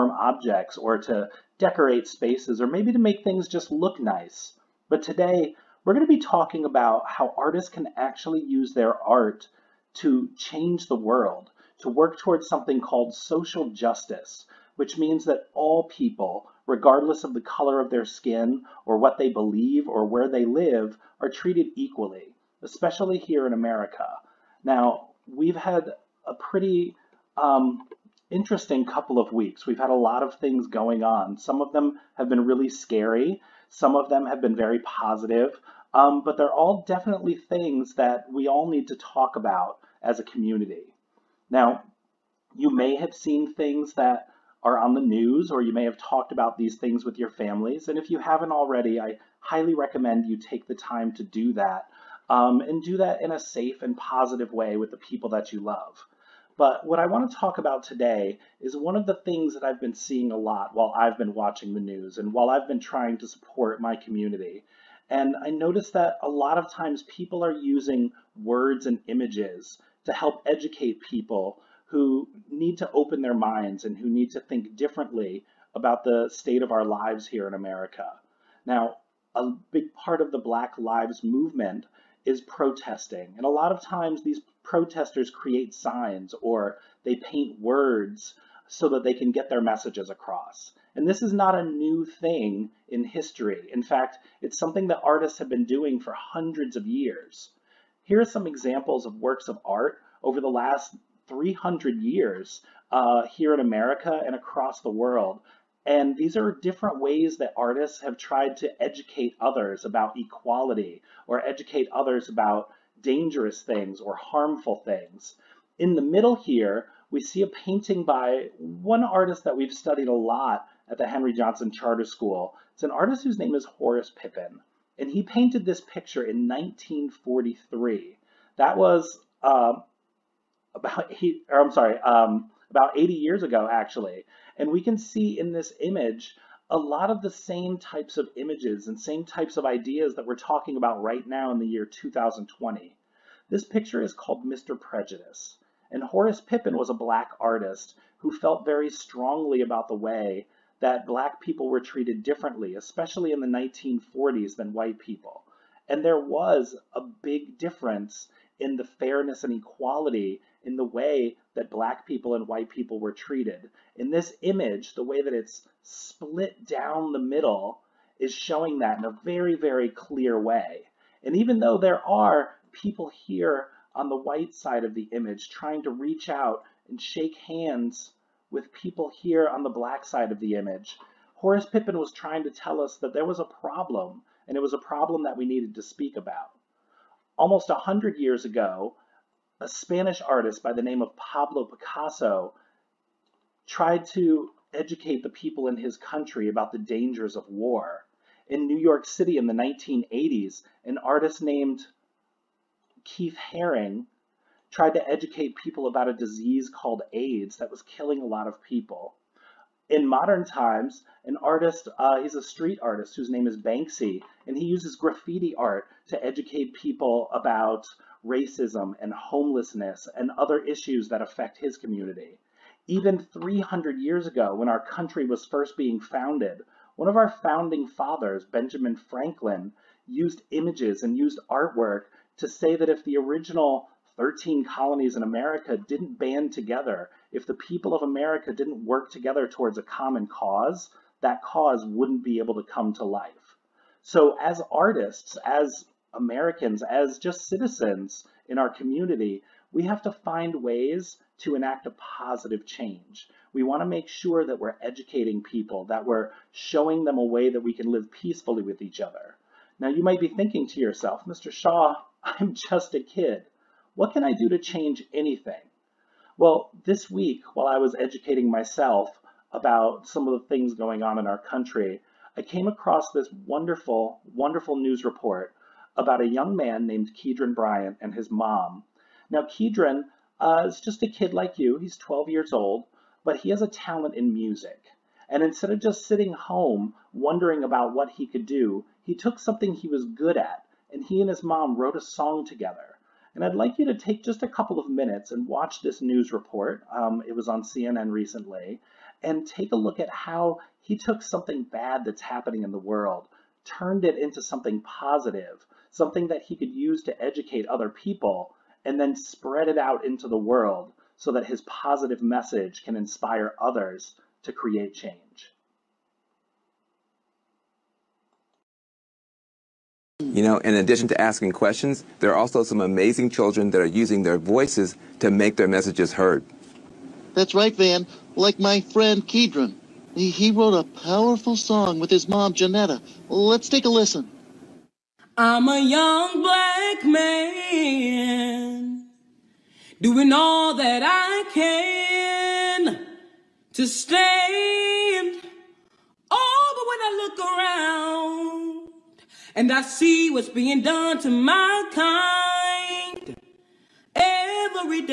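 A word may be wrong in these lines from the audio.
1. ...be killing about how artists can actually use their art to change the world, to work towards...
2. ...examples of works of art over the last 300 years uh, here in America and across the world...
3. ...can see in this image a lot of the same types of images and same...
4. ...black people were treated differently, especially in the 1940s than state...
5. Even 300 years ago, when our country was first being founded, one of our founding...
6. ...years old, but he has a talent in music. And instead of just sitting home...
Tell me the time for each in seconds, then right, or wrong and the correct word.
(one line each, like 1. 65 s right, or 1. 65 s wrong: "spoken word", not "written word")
1. 6 s wrong: "talking", not "killing"
2. 98 s right
3. 134 s right
4. 151 s wrong: "white", not "state"
5. 222 s right
6. 282 s right.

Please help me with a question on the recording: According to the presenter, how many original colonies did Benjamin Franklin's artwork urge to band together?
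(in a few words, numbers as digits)
13.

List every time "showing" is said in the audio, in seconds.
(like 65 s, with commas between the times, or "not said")
168 s, 256 s.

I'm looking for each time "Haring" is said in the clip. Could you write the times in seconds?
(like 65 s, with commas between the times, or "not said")
203 s.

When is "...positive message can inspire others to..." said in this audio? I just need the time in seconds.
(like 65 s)
311 s.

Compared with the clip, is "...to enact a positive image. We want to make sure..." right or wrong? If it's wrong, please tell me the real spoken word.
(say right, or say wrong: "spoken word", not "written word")
wrong: "change", not "image".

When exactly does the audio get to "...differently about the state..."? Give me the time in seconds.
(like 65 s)
74 s.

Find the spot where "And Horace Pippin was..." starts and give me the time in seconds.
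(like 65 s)
145 s.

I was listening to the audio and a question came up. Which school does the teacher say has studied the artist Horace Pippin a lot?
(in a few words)
Henry Johnson Charter School.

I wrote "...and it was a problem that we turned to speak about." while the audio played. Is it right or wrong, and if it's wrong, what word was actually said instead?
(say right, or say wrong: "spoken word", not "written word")
wrong: "needed", not "turned".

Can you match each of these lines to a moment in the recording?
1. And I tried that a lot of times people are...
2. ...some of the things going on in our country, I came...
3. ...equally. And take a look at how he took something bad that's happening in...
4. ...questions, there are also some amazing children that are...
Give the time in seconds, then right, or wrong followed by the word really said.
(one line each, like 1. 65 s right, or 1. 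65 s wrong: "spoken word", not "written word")
1. 65 s wrong: "noticed", not "tried"
2. 270 s right
3. 298 s wrong: "recently", not "equally"
4. 321 s right.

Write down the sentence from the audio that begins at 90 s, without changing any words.
And this is not a new thing in history.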